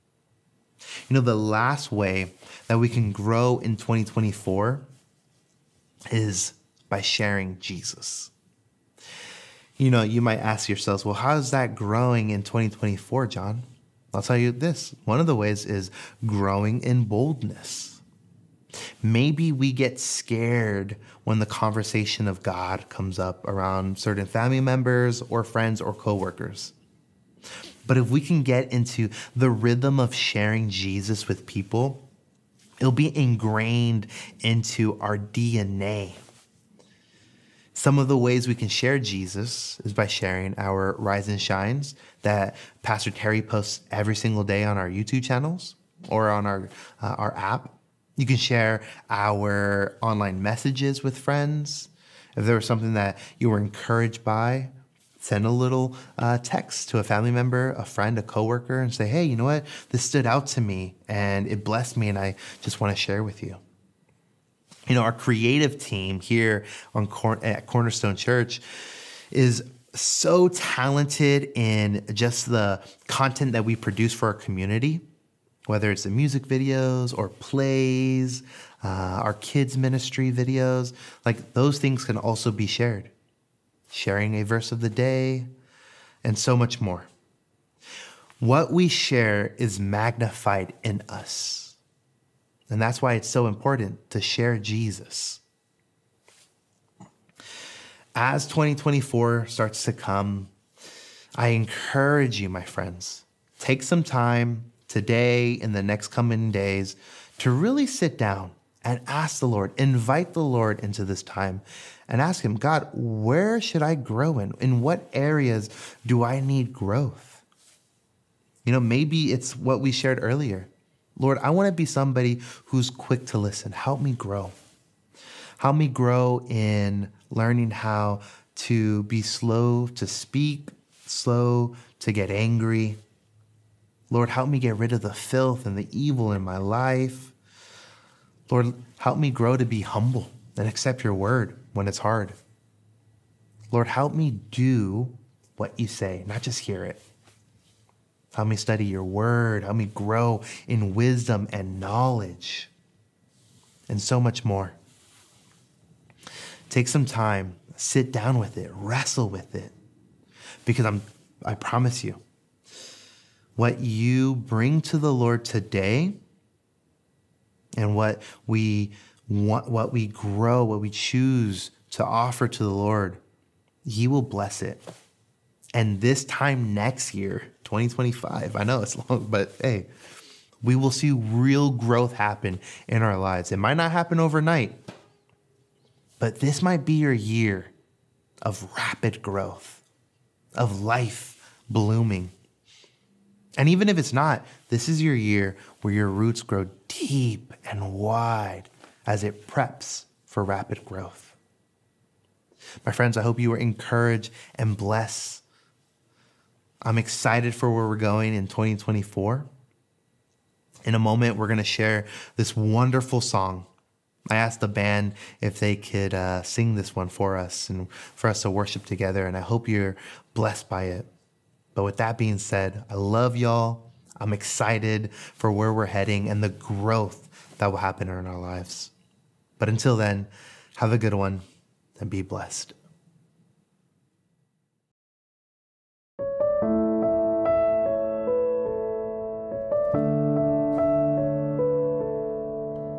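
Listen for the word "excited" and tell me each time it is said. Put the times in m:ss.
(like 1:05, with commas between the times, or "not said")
3:26, 3:44.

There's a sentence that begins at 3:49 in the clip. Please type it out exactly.
But until then, have a good one and be blessed.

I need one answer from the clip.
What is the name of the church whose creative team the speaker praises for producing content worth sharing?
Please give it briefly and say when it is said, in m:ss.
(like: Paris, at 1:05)
Cornerstone Church, at 1:07.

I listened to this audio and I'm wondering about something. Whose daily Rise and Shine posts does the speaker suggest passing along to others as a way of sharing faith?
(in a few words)
Pastor Terry.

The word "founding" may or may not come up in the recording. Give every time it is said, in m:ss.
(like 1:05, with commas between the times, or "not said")
not said.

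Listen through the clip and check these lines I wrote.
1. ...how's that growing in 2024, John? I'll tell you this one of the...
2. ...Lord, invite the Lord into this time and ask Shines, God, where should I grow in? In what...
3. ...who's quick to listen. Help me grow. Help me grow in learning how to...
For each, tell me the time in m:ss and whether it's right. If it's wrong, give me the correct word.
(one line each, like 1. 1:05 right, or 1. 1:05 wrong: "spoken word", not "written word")
1. 0:11 right
2. 1:49 wrong: "Him", not "Shines"
3. 2:02 right.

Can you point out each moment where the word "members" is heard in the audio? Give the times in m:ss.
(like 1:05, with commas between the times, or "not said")
0:24, 0:57.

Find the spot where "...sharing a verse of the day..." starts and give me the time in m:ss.
1:23.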